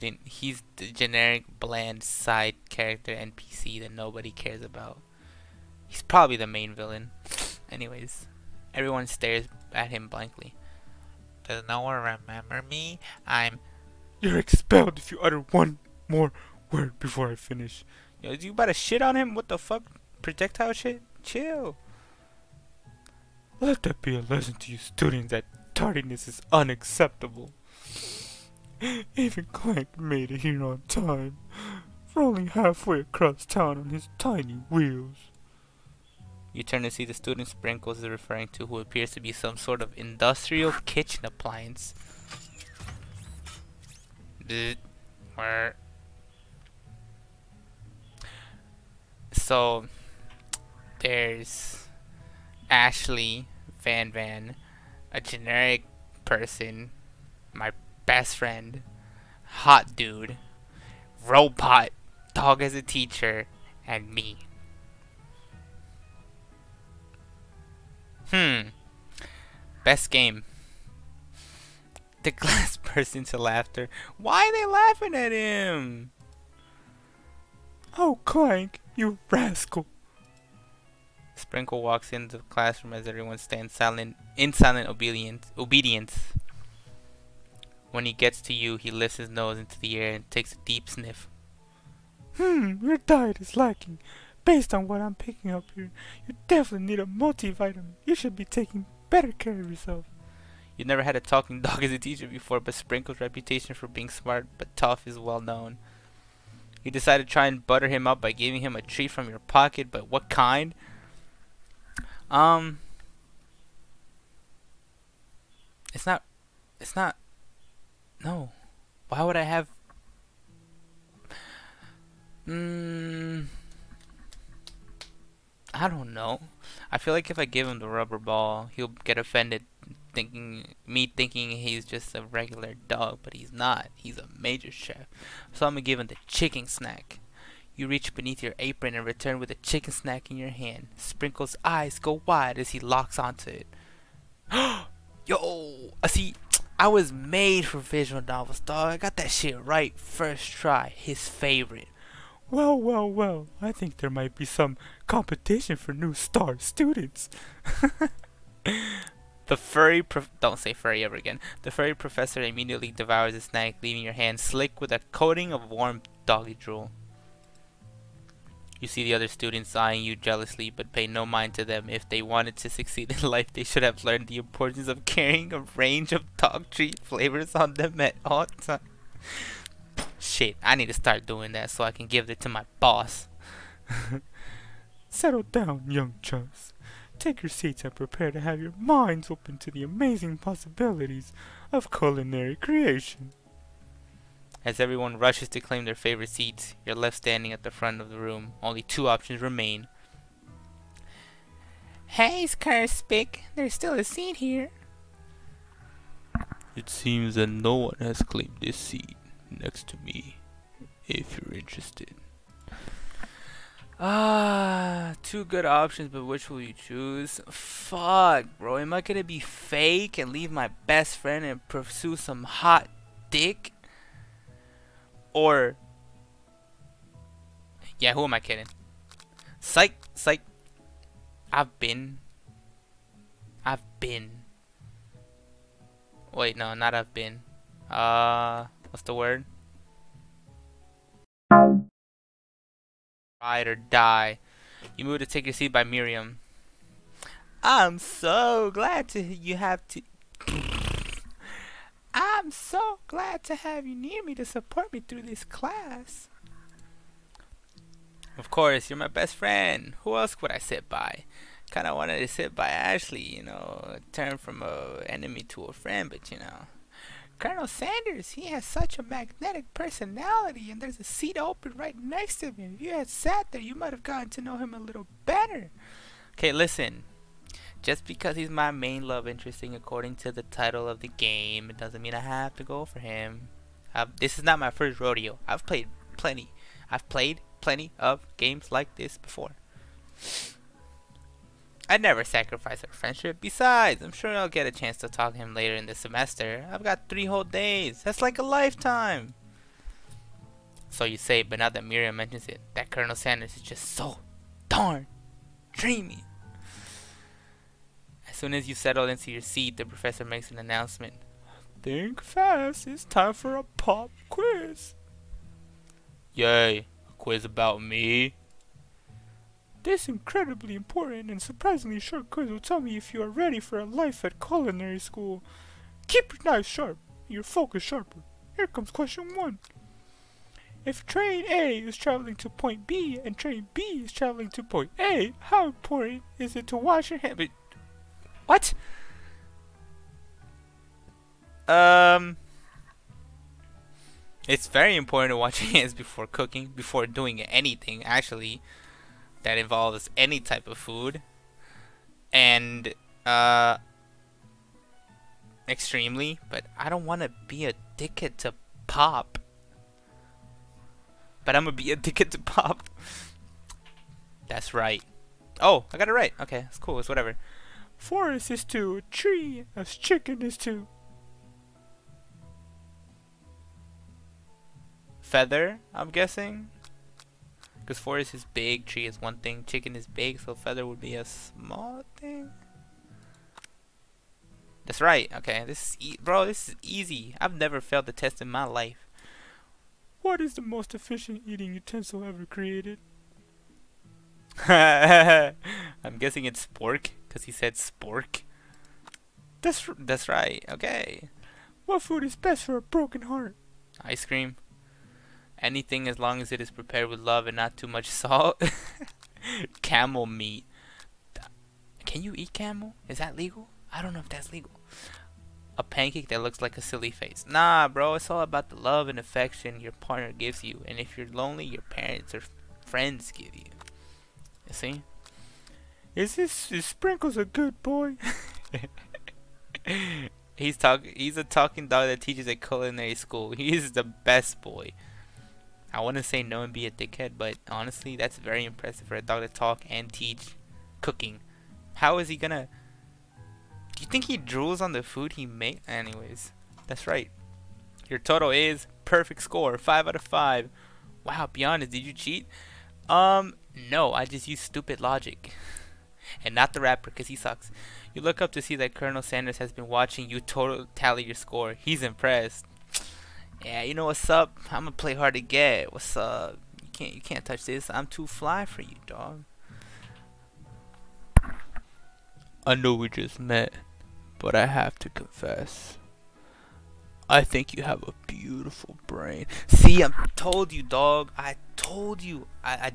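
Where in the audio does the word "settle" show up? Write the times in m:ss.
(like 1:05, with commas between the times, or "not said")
3:05, 5:08.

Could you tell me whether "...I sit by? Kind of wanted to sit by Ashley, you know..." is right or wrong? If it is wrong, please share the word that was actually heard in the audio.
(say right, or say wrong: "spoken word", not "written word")
right.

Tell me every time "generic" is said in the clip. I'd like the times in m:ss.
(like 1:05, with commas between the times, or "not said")
0:00, 0:55.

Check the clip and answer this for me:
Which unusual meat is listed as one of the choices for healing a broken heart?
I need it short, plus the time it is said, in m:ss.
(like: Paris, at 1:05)
camel meat, at 6:49.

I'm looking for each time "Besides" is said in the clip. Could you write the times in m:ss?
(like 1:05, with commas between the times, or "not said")
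4:53.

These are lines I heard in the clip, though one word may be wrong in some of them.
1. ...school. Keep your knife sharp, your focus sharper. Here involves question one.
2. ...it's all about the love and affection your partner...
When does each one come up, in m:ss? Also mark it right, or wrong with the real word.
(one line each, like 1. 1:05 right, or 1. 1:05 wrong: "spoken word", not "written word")
1. 5:24 wrong: "comes", not "involves"
2. 6:58 right.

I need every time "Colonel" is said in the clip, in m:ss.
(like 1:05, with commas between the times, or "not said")
4:27, 5:02, 7:38.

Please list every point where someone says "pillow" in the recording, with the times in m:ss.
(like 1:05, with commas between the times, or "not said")
not said.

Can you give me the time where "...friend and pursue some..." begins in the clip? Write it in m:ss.
3:41.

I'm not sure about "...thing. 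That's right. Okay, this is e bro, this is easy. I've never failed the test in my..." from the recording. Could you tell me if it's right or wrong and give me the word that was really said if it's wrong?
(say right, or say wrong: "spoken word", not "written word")
right.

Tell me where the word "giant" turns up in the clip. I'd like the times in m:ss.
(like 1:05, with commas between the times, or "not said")
not said.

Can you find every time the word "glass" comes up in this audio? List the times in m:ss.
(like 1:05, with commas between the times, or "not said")
1:12.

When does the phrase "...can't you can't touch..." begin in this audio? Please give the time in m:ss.
7:46.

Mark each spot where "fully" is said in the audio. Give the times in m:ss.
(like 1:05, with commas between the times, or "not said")
not said.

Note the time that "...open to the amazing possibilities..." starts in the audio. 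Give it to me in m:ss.
3:09.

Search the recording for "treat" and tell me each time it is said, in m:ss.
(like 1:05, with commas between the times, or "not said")
1:48, 2:56.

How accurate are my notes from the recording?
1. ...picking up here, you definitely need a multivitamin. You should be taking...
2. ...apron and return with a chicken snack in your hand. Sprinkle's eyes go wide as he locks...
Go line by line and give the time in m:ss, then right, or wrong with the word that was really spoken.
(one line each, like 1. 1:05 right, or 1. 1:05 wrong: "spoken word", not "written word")
1. 1:35 right
2. 2:18 right.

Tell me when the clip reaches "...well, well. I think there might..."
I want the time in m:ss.
2:32.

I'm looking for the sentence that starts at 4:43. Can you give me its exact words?
I've, this is not my first rodeo.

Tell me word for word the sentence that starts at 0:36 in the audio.
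You turn to see the student Sprinkles is referring to who appears to be some sort of industrial kitchen appliance.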